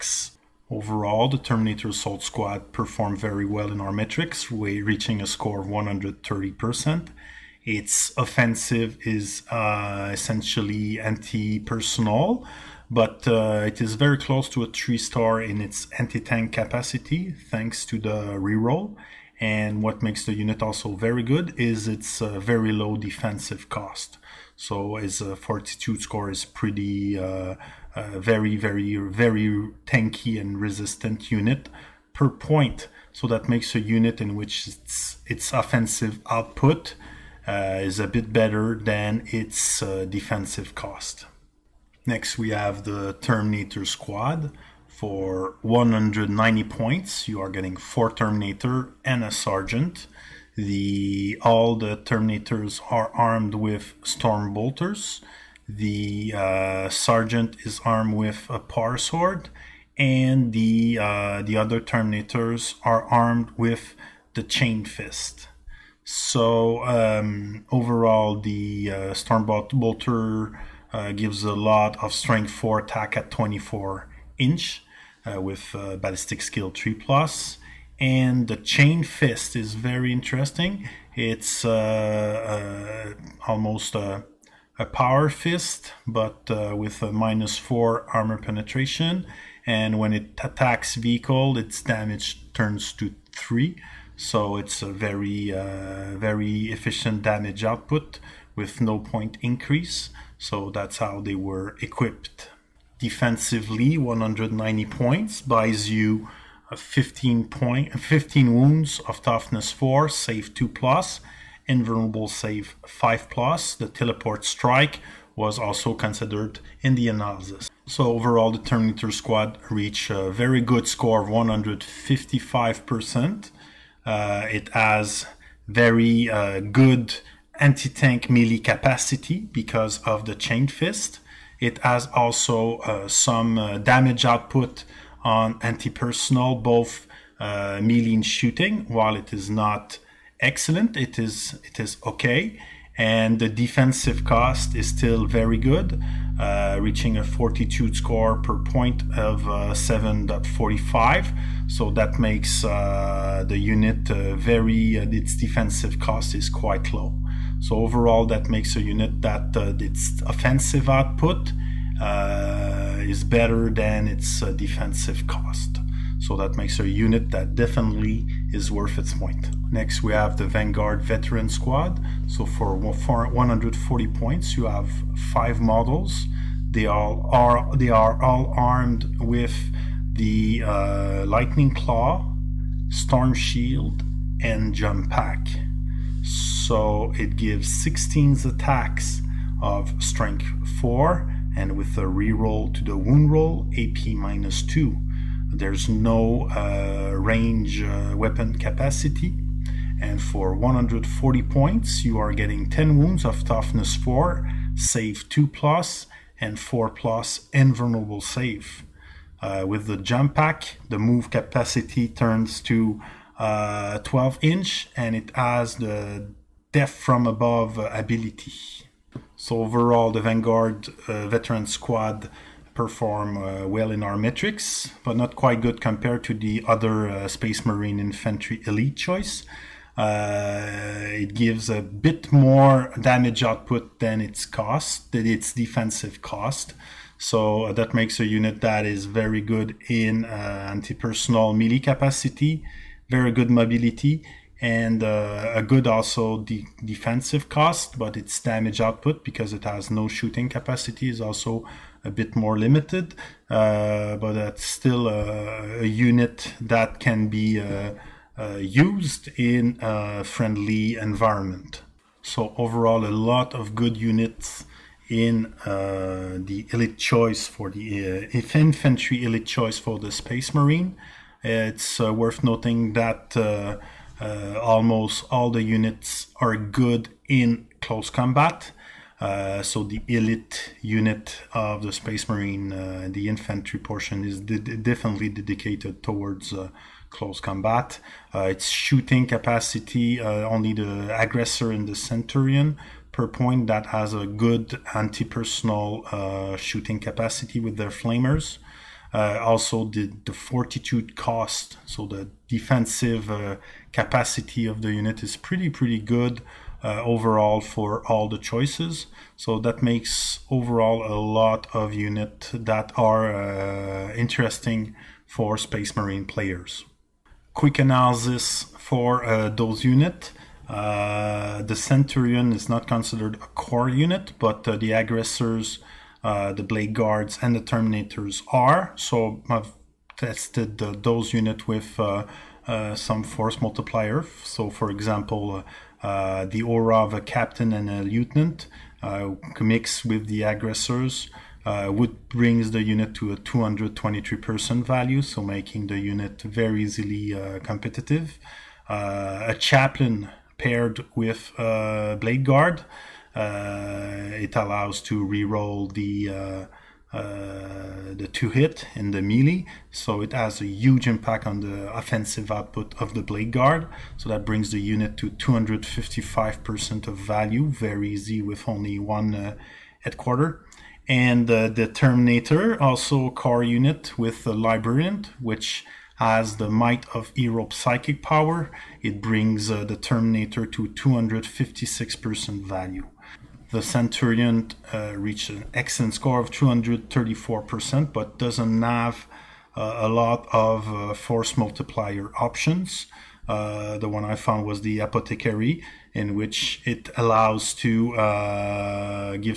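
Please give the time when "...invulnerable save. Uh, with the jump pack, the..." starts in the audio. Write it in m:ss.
3:27.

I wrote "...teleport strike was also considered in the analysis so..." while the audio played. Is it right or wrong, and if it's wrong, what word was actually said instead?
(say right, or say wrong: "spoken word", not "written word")
right.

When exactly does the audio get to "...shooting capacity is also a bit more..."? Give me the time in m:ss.
4:10.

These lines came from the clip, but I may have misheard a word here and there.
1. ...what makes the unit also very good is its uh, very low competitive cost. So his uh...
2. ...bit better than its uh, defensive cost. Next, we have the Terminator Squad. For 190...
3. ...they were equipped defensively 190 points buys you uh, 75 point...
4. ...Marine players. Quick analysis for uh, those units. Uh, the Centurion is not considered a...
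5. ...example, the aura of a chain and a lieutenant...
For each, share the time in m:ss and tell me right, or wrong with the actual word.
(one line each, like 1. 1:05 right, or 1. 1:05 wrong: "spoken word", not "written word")
1. 0:19 wrong: "defensive", not "competitive"
2. 0:38 right
3. 1:41 wrong: "15", not "75"
4. 5:15 right
5. 5:34 wrong: "captain", not "chain".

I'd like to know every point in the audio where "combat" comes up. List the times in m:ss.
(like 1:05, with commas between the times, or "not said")
4:38, 4:47.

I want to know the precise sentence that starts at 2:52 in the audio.
So for 140 points, you have five models.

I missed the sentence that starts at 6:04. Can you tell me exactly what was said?
So that brings the unit to 255% of value, very easy with only one uh, headquarter.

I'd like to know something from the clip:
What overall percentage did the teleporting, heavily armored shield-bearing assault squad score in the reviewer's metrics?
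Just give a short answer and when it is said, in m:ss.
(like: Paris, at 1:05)
130%, at 0:05.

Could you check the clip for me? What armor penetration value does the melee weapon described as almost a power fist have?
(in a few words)
-4.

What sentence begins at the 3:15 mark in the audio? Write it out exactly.
There's no uh, range uh, weapon capacity.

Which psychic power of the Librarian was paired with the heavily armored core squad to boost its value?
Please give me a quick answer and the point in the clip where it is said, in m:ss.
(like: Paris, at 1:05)
Might of Heroes, at 6:16.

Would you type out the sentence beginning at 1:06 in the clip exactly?
So um, overall, the uh, Stormbolt Bolter uh, gives a lot of strength for attack at 24 inch.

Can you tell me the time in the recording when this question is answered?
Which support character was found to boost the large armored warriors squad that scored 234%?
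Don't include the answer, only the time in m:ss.
6:34.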